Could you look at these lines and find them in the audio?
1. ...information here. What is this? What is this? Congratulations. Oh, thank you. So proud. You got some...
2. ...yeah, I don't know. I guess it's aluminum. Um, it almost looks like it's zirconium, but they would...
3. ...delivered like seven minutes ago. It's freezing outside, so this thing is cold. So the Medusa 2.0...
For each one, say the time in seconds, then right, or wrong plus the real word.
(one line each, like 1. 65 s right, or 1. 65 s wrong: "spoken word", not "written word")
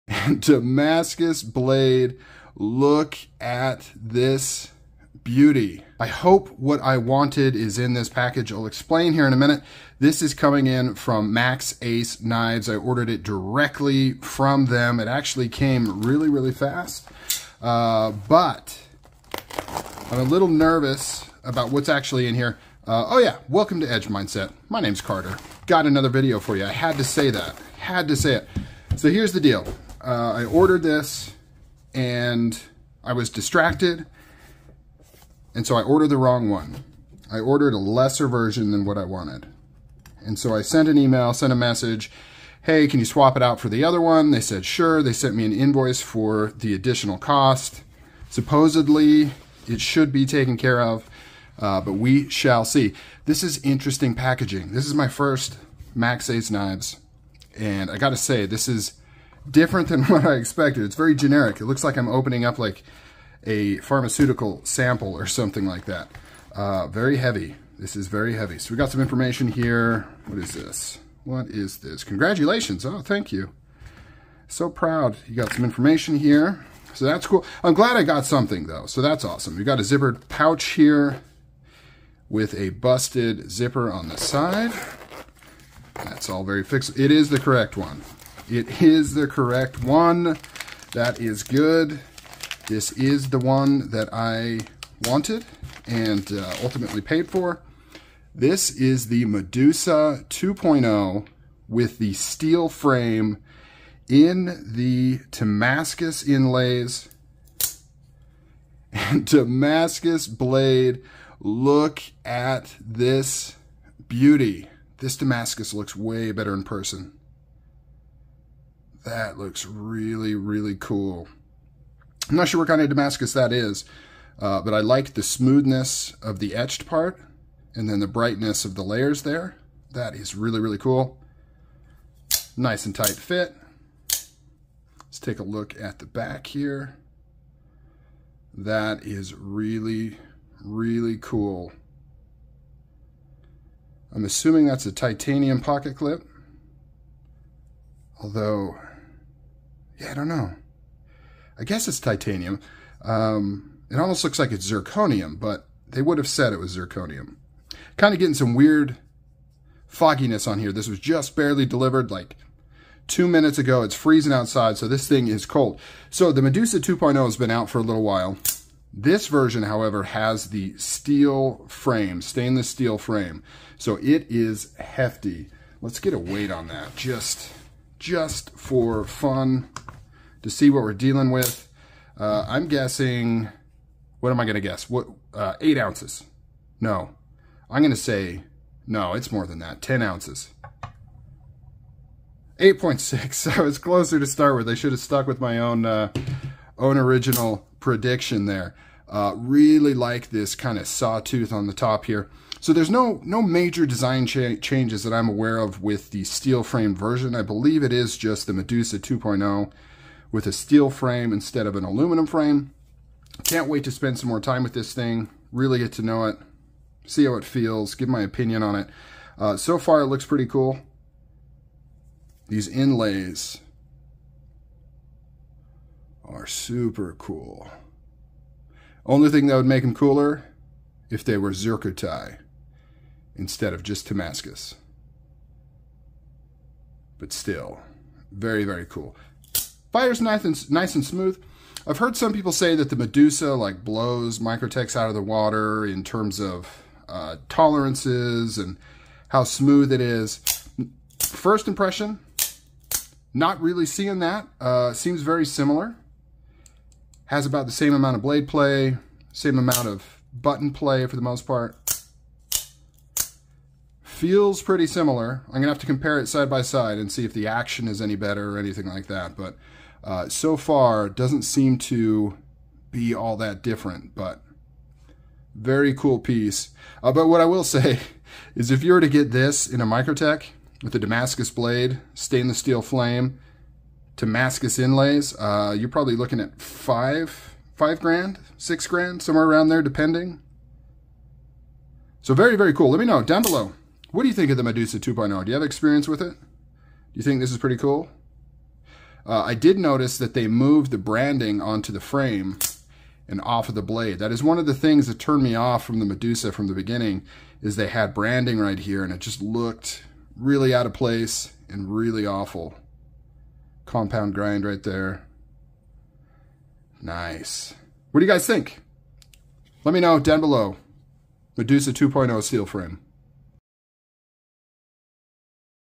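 1. 69 s right
2. 150 s wrong: "titanium", not "aluminum"
3. 161 s wrong: "two", not "seven".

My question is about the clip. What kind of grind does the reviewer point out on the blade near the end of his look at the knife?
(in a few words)
Compound grind.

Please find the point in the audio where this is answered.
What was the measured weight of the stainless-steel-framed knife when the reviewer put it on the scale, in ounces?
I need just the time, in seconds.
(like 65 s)
192 s.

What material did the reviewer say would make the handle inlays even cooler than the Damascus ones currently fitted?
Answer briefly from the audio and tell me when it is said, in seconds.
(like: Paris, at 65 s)
Zircuti, at 231 s.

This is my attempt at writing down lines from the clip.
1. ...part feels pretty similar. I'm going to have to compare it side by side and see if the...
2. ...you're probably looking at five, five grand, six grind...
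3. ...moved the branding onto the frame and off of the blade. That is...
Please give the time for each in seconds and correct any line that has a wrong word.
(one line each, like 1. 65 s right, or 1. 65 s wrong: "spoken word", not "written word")
1. 261 s right
2. 285 s wrong: "grand", not "grind"
3. 300 s right.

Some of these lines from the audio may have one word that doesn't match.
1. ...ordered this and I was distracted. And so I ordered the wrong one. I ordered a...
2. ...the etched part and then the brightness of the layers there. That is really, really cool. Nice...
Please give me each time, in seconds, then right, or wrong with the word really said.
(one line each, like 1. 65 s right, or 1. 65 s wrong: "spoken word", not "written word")
1. 30 s right
2. 126 s right.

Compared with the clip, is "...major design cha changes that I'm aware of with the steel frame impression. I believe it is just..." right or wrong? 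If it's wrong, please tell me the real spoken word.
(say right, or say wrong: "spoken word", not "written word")
wrong: "version", not "impression".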